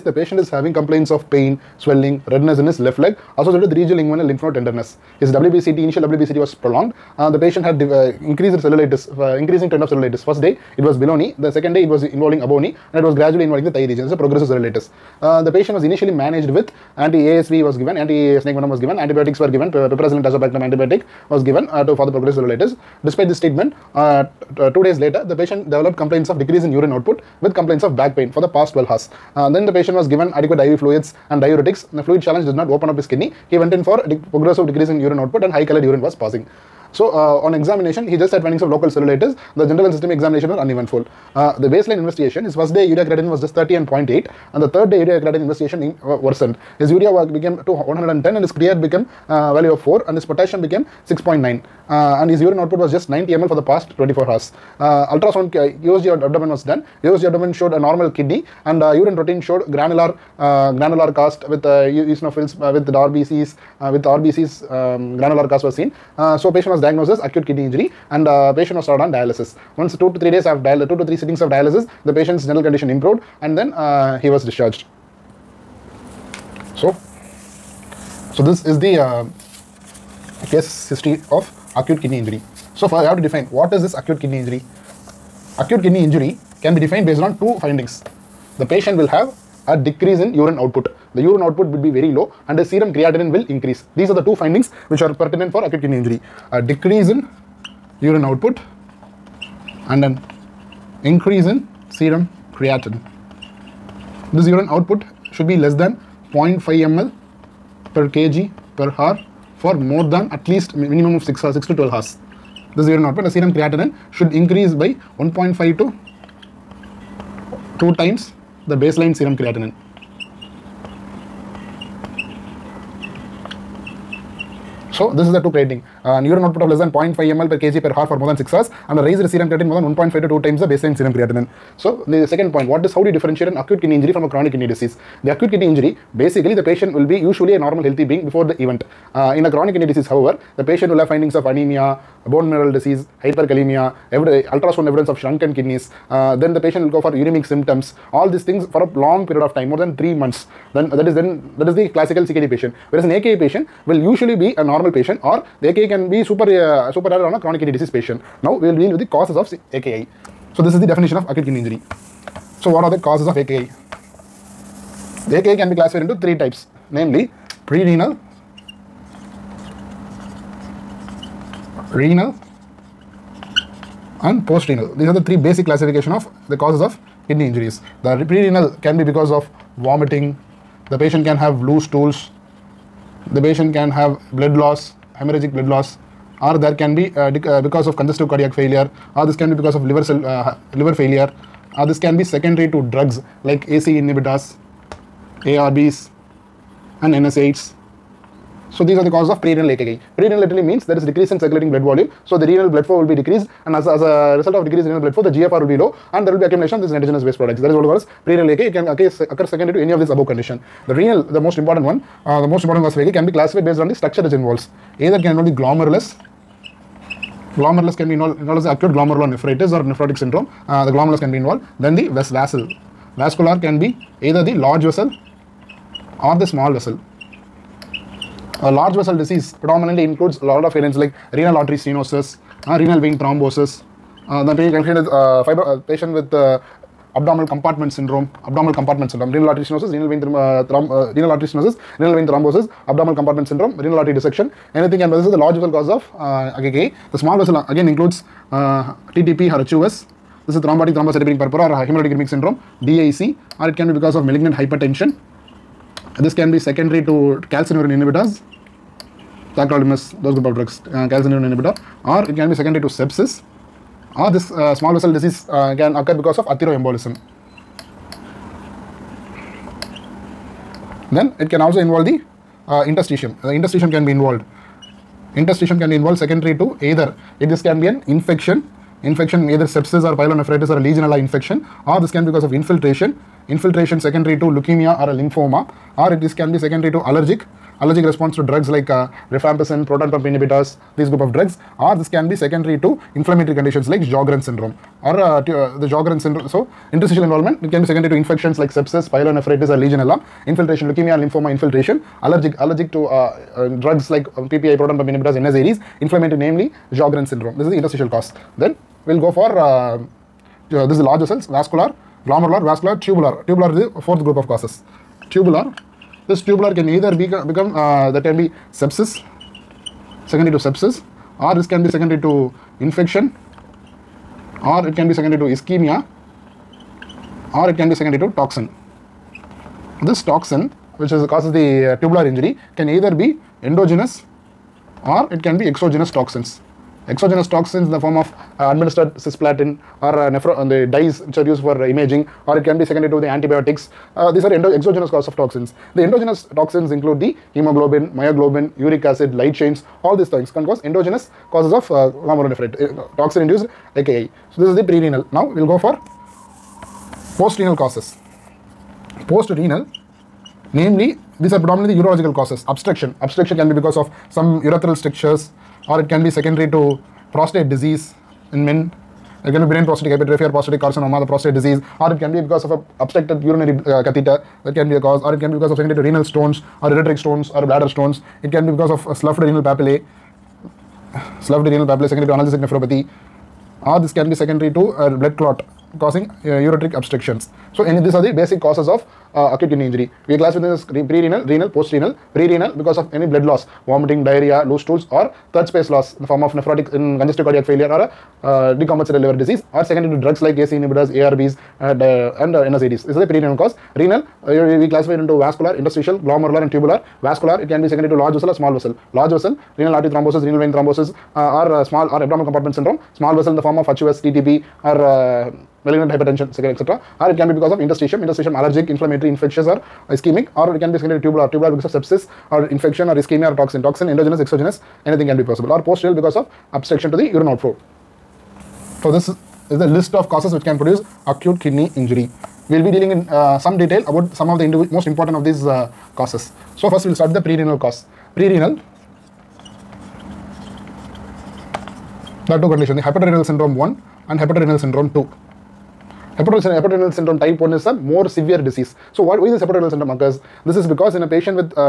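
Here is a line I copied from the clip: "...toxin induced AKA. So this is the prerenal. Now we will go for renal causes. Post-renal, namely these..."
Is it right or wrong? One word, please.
wrong.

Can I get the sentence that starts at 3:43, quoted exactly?
Vascular can be either the large vessel or the small vessel.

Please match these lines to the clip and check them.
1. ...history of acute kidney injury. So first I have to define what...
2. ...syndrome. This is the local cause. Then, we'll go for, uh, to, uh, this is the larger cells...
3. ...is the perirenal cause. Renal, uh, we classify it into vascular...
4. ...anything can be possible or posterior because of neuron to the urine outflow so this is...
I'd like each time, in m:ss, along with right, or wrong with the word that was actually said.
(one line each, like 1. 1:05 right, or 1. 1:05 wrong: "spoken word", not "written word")
1. 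1:20 right
2. 5:07 wrong: "interstitial", not "local"
3. 6:43 right
4. 7:05 wrong: "obstruction", not "neuron".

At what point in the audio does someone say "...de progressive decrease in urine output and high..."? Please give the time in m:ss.
0:34.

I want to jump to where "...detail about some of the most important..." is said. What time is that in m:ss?
7:13.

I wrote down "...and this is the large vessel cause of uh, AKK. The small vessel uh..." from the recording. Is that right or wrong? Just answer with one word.
right.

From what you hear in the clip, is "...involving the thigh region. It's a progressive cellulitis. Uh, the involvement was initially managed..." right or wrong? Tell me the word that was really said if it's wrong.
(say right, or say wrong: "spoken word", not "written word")
wrong: "patient", not "involvement".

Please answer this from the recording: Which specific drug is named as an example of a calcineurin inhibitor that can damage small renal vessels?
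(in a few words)
Tacrolimus.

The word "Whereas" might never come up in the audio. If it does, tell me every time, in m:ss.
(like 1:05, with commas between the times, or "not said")
2:32.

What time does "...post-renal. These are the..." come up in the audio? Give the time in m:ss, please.
2:54.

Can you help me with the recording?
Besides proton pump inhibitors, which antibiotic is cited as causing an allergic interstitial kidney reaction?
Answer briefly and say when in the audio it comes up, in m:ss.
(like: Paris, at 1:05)
Rifampicin, at 4:49.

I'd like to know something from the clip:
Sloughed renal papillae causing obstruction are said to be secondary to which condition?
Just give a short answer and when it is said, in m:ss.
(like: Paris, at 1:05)
Analgesic nephropathy, at 6:22.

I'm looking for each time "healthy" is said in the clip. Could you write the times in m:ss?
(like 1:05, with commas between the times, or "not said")
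2:17.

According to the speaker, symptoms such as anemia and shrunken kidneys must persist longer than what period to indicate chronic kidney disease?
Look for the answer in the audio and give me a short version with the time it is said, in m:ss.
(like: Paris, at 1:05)
3 months, at 2:29.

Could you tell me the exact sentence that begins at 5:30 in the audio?
This toxin which is, causes the uh, tubular injury can either be endogenous or it can be exogenous toxins.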